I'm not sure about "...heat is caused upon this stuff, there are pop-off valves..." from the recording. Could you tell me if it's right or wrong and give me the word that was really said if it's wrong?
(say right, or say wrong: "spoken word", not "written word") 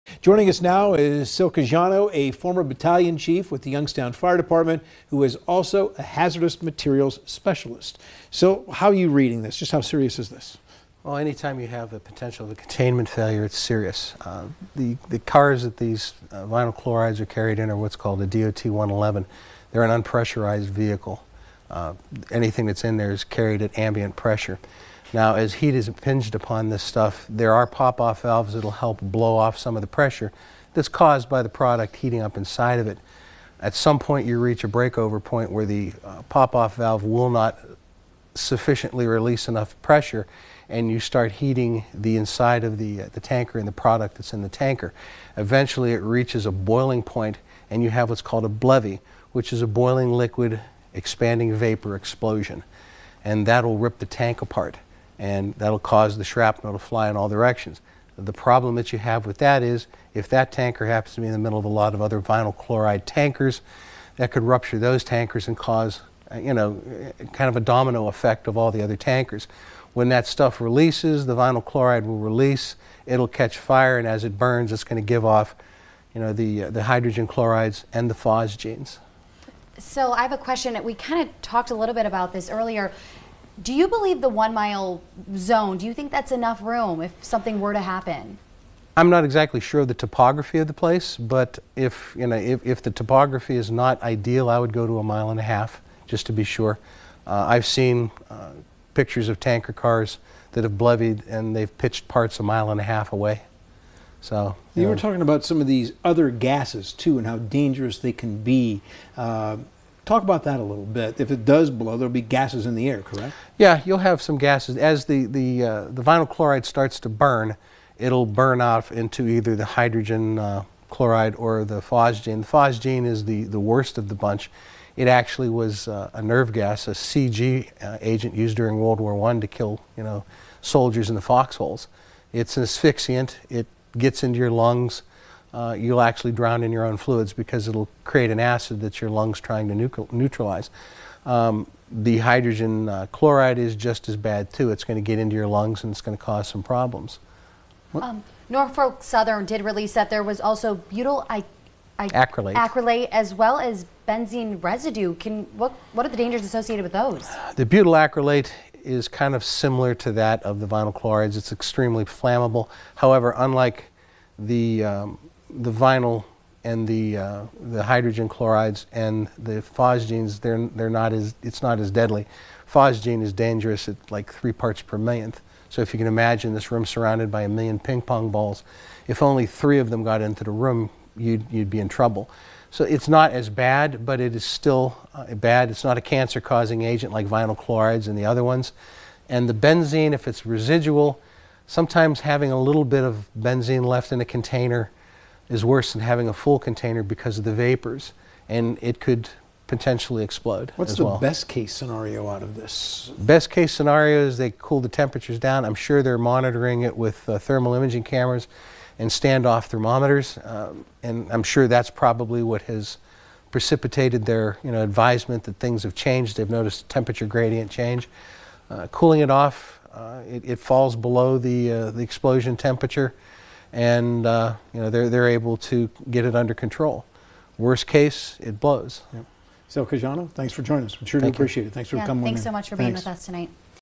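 wrong: "impinged", not "caused".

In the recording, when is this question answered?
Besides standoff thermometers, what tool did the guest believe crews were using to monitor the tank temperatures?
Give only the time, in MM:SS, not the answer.
03:27.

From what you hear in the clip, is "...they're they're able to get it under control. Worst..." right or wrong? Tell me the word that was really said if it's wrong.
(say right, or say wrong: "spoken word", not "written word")
right.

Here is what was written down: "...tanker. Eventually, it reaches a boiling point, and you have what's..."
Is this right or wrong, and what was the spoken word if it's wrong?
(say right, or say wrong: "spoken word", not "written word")
right.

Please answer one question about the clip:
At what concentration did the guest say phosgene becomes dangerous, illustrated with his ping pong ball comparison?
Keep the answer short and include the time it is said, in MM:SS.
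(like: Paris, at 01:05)
3 parts per million, at 02:54.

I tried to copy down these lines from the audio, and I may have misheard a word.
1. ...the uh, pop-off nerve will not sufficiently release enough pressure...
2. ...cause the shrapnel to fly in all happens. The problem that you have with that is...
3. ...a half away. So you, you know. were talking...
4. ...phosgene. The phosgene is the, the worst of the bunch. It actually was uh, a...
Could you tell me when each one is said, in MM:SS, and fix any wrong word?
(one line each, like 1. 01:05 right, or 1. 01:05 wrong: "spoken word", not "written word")
1. 00:35 wrong: "valve", not "nerve"
2. 00:55 wrong: "directions", not "happens"
3. 01:42 right
4. 02:01 right.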